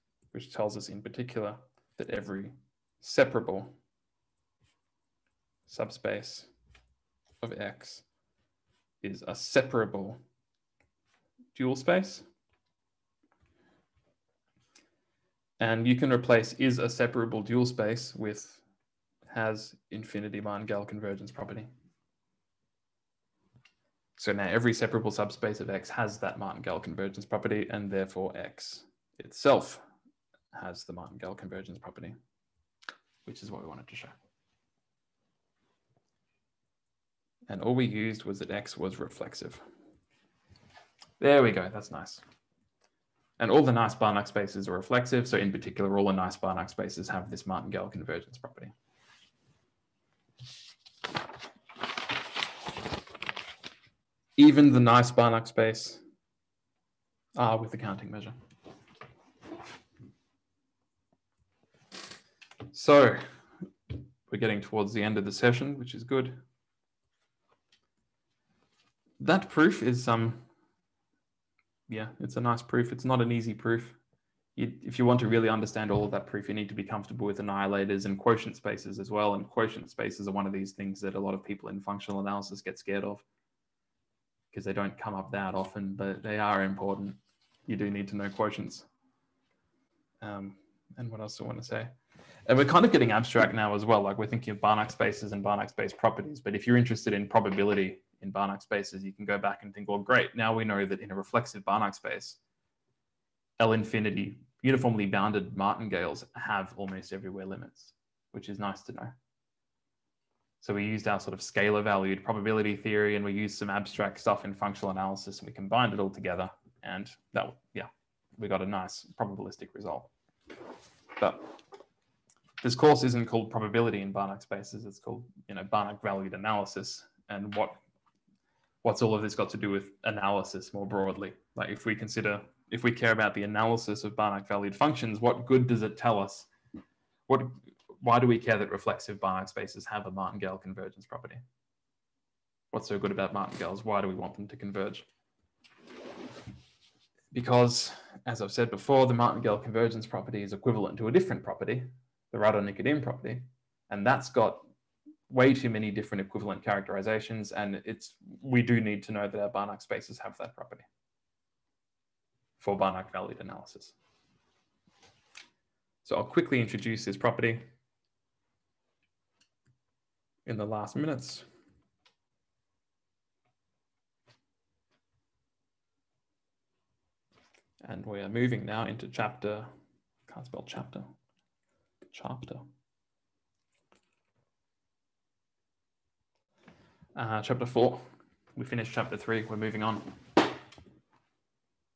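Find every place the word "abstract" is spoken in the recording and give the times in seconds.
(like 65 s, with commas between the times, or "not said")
93 s, 113 s.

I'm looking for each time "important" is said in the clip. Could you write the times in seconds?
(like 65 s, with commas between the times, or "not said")
86 s.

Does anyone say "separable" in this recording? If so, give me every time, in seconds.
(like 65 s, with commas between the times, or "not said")
2 s, 9 s, 16 s, 24 s.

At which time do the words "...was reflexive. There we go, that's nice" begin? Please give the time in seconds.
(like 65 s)
38 s.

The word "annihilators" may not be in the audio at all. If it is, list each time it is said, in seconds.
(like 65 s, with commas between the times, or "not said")
77 s.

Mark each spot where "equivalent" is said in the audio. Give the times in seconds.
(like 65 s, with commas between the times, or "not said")
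150 s, 156 s.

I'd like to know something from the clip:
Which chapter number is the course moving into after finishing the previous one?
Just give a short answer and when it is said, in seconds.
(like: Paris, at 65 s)
4, at 187 s.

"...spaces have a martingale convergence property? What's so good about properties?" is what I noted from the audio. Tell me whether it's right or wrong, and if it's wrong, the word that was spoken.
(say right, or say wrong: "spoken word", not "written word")
wrong: "martingales", not "properties".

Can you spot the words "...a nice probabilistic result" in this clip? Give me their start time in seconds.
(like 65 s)
118 s.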